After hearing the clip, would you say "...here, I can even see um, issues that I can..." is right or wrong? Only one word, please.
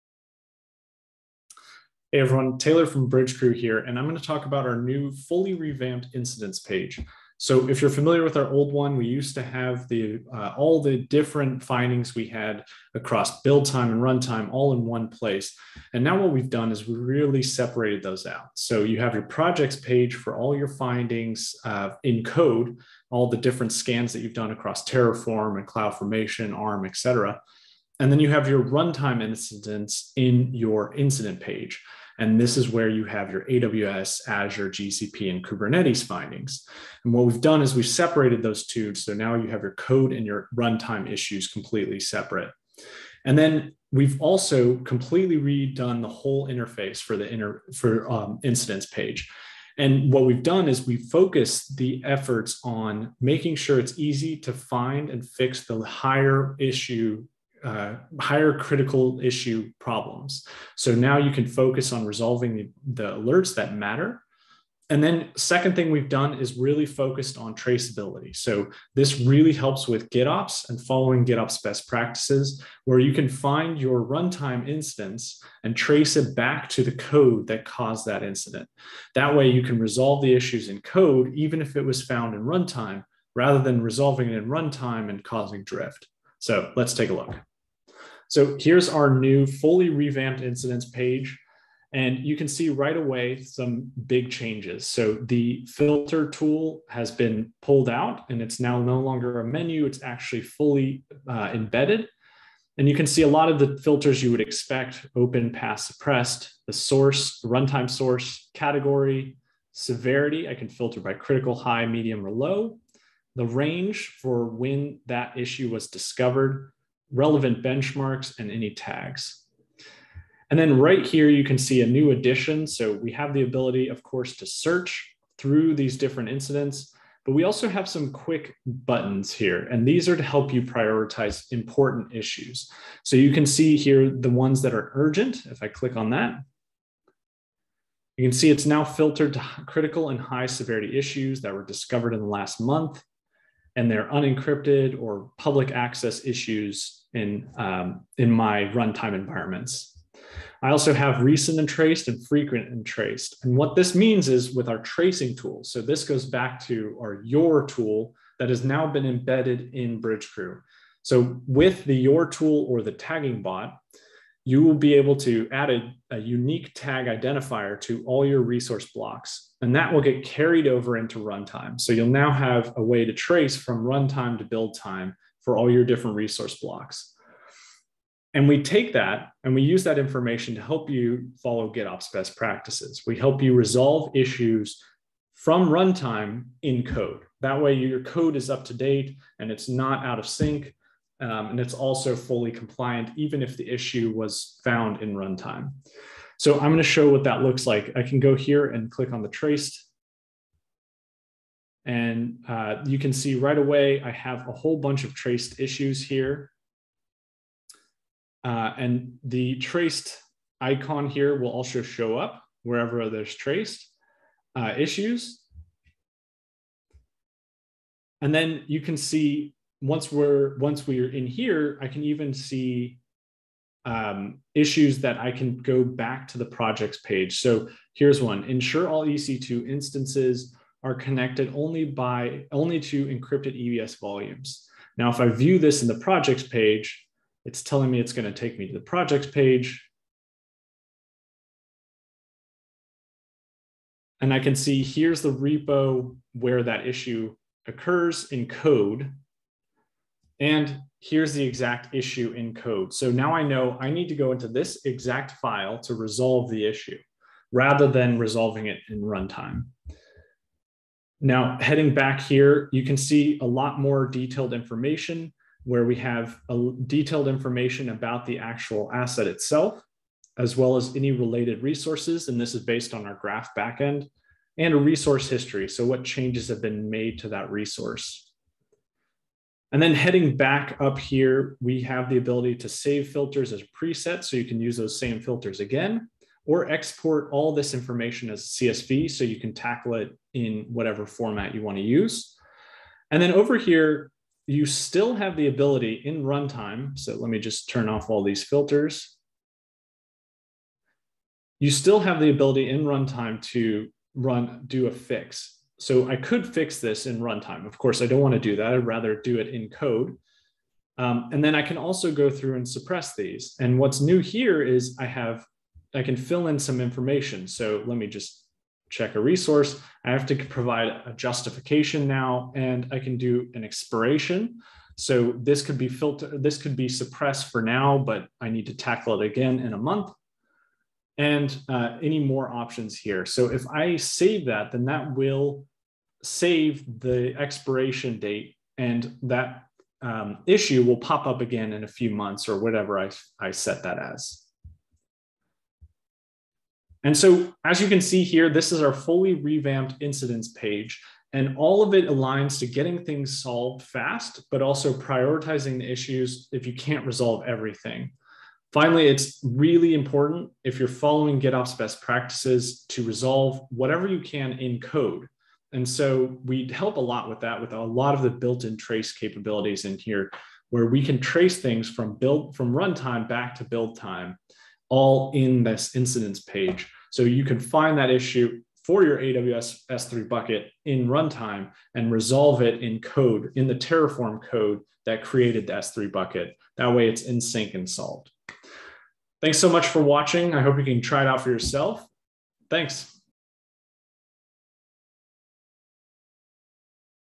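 right.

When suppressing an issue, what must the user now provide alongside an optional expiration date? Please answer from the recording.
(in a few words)
a justification.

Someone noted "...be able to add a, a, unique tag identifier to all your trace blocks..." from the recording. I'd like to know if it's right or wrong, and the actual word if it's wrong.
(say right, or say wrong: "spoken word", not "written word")
wrong: "resource", not "trace".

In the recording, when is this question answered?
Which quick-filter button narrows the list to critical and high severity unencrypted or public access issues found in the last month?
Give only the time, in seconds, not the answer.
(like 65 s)
134 s.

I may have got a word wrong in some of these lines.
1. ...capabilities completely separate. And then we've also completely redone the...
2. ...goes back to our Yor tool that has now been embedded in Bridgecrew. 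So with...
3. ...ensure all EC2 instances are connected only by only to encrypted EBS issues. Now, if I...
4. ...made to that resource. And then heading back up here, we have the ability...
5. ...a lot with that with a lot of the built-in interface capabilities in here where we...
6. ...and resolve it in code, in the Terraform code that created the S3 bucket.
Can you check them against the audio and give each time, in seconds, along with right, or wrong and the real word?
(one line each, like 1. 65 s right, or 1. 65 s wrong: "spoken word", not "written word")
1. 41 s wrong: "issues", not "capabilities"
2. 156 s right
3. 228 s wrong: "volumes", not "issues"
4. 276 s right
5. 366 s wrong: "trace", not "interface"
6. 381 s right.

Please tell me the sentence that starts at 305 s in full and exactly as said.
So I could fix this in runtime.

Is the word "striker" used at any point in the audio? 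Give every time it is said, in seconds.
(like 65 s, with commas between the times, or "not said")
not said.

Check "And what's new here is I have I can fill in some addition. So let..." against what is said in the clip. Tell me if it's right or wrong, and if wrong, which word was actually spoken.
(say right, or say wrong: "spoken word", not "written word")
wrong: "information", not "addition".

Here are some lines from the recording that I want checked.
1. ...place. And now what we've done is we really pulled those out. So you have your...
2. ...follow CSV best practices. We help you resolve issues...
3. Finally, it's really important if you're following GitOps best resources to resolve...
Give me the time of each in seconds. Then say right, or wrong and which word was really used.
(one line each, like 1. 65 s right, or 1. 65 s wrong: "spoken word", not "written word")
1. 15 s wrong: "separated", not "pulled"
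2. 181 s wrong: "GitOps", not "CSV"
3. 358 s wrong: "practices", not "resources".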